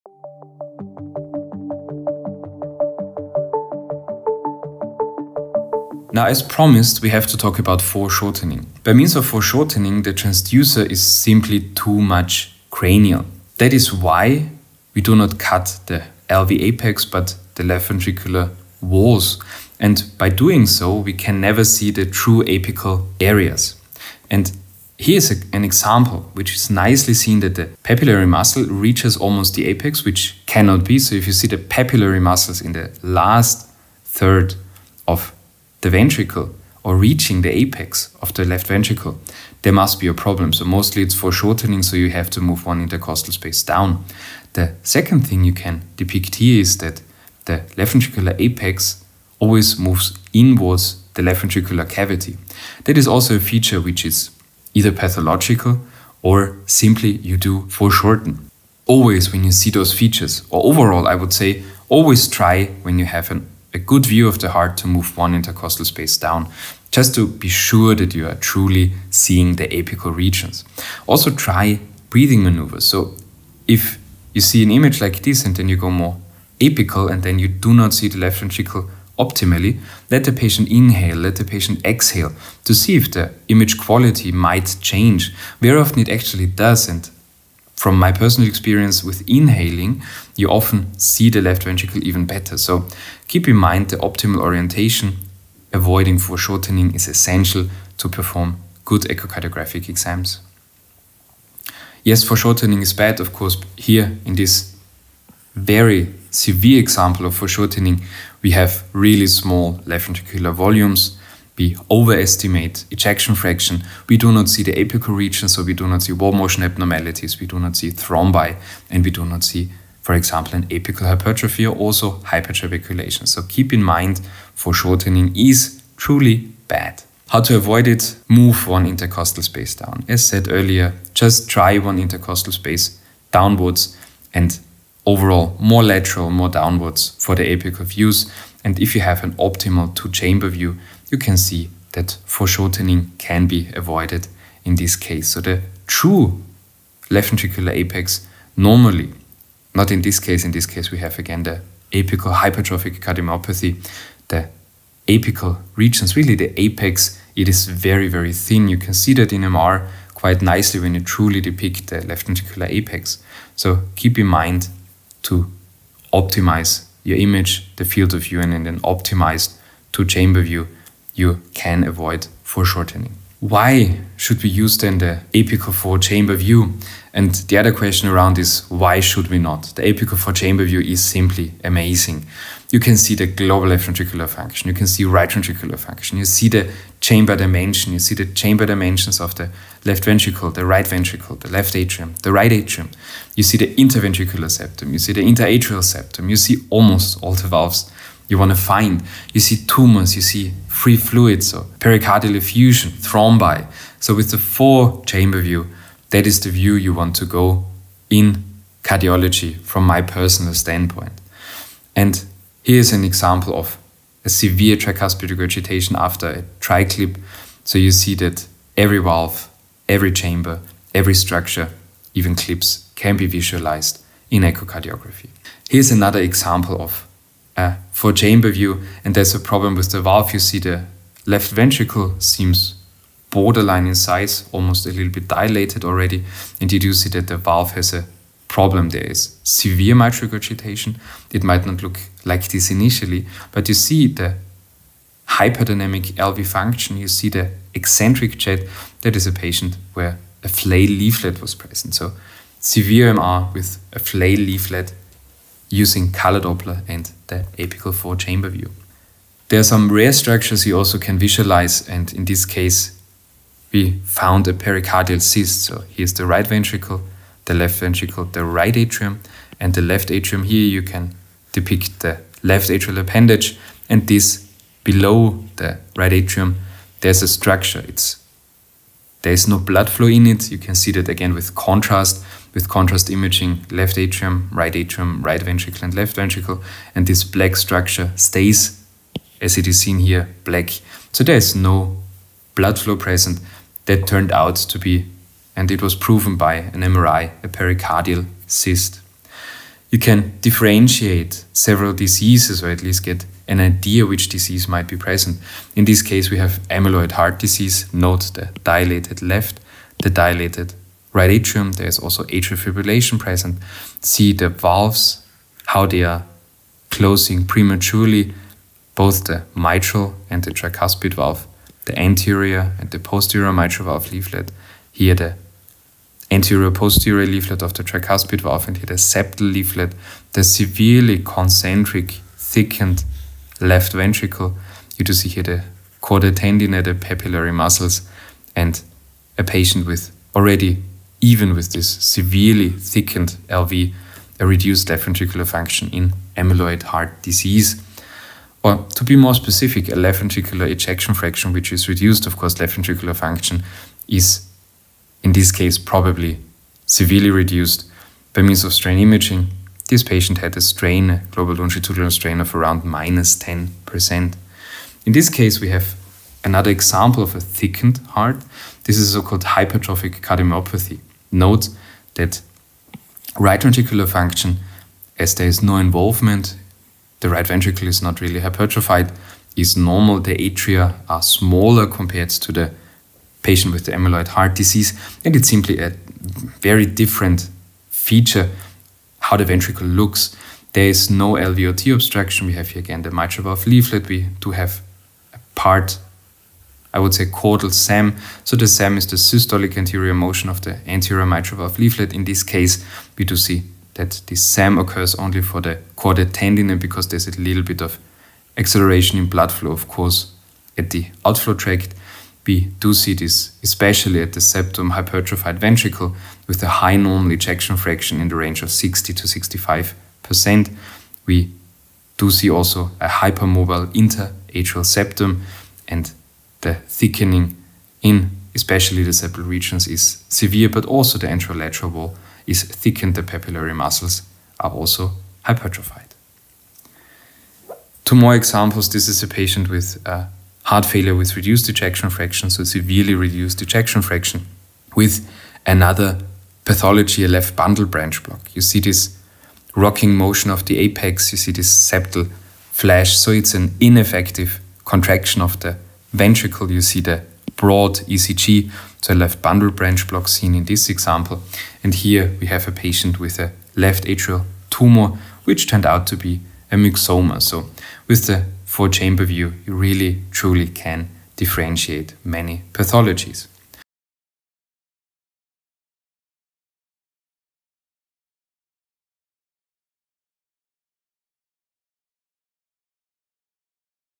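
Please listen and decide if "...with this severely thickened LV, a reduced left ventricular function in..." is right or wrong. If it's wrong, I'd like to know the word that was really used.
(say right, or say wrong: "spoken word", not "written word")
right.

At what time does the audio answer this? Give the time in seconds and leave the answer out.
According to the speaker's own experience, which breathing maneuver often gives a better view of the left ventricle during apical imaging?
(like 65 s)
89 s.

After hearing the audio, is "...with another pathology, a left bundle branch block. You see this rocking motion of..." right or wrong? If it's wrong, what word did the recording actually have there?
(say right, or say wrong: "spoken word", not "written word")
right.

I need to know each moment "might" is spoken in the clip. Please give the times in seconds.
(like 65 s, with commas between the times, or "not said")
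84 s, 241 s, 304 s.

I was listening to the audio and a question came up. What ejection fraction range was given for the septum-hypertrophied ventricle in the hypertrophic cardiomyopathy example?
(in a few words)
60 to 65%.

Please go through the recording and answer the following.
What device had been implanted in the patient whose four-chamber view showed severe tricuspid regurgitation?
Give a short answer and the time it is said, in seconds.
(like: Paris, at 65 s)
TriClip, at 216 s.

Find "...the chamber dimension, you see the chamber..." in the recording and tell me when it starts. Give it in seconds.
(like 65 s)
186 s.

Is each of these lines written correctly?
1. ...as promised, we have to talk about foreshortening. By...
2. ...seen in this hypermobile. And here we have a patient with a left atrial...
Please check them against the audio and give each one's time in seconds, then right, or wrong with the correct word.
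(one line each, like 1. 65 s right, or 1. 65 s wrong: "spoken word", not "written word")
1. 6 s right
2. 460 s wrong: "example", not "hypermobile".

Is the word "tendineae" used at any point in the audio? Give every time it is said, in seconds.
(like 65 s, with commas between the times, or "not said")
336 s, 406 s.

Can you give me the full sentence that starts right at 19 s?
And by doing so, we can never see the true apical areas.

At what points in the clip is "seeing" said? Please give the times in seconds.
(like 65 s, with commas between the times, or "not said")
69 s.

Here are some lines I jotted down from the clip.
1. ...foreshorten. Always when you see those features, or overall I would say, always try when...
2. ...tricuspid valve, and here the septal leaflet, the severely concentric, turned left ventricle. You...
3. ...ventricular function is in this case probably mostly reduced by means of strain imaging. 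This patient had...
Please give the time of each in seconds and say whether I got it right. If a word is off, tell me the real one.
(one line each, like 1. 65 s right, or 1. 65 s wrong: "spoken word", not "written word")
1. 57 s right
2. 327 s wrong: "thickened", not "turned"
3. 352 s wrong: "severely", not "mostly".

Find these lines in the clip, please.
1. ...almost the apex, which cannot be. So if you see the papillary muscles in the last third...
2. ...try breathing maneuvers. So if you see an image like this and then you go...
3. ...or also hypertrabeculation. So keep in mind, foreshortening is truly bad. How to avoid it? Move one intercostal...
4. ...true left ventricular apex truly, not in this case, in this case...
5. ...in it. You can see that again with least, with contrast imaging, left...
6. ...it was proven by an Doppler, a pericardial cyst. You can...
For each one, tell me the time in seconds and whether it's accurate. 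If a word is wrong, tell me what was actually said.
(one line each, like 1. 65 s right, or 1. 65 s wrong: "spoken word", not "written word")
1. 29 s right
2. 71 s right
3. 121 s right
4. 145 s wrong: "normally", not "truly"
5. 280 s wrong: "contrast", not "least"
6. 295 s wrong: "MRI", not "Doppler".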